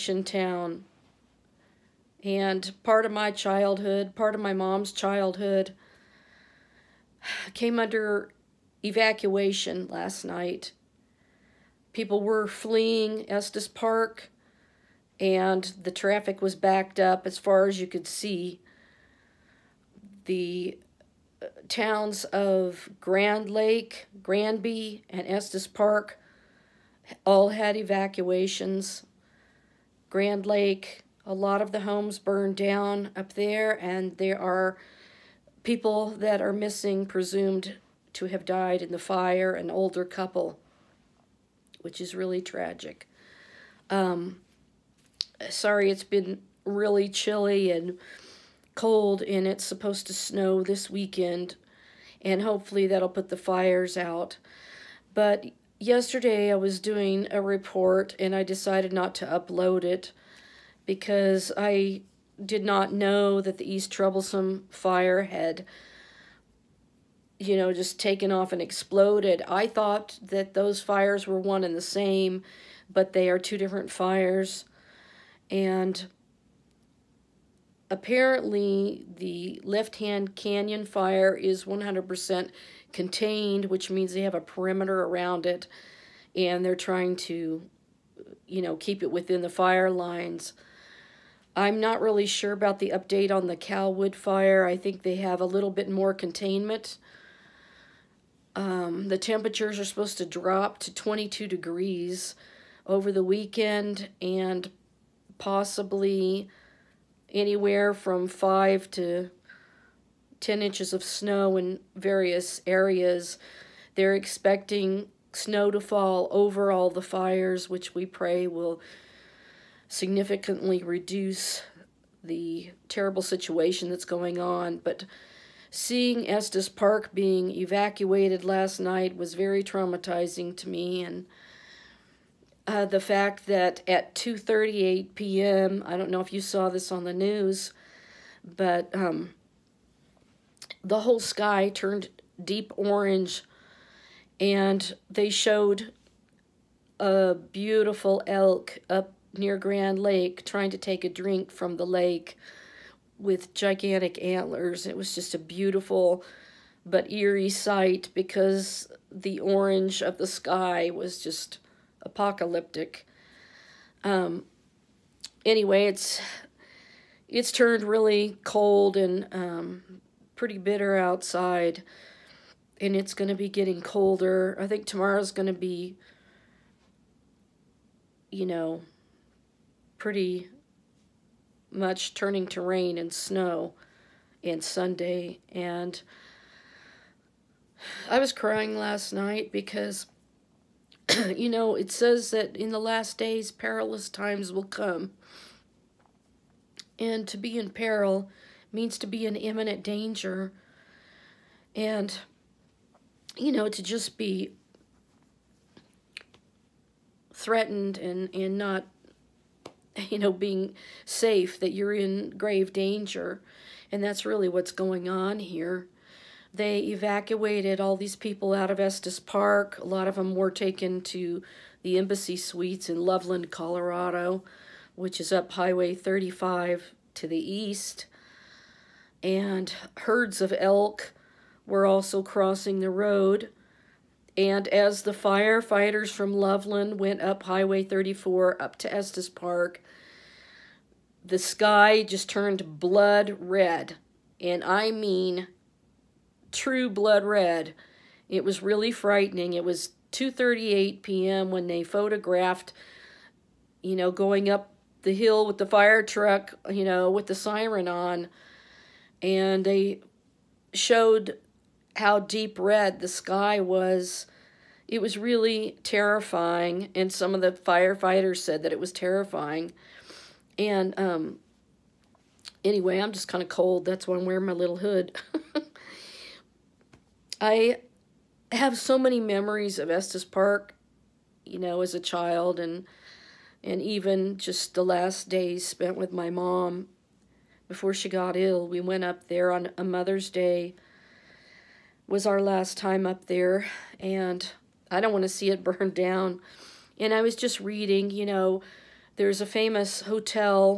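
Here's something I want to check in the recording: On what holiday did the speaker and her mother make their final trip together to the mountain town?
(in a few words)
Mother's Day.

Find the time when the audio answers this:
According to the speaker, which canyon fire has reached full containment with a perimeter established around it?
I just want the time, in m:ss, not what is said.
1:19.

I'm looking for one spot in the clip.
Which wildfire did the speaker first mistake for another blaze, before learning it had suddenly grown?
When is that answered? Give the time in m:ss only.
1:03.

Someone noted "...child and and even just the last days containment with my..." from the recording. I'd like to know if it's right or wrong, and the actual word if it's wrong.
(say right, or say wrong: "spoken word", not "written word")
wrong: "spent", not "containment".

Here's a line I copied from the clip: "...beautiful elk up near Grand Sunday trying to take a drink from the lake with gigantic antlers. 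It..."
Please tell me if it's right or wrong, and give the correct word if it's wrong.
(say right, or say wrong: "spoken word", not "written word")
wrong: "Lake", not "Sunday".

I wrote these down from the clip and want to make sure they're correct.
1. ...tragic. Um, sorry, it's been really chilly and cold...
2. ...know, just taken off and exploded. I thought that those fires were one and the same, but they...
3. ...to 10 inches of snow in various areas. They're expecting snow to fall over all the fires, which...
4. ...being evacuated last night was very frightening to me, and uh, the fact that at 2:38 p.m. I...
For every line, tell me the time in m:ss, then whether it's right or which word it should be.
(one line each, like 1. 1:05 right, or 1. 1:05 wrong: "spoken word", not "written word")
1. 0:42 right
2. 1:07 right
3. 1:48 right
4. 2:07 wrong: "traumatizing", not "frightening".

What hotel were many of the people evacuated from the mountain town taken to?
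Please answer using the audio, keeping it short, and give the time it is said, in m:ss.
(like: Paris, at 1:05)
Embassy Suites, at 3:41.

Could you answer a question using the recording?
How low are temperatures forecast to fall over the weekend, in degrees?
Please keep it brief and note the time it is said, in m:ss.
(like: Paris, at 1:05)
22, at 1:40.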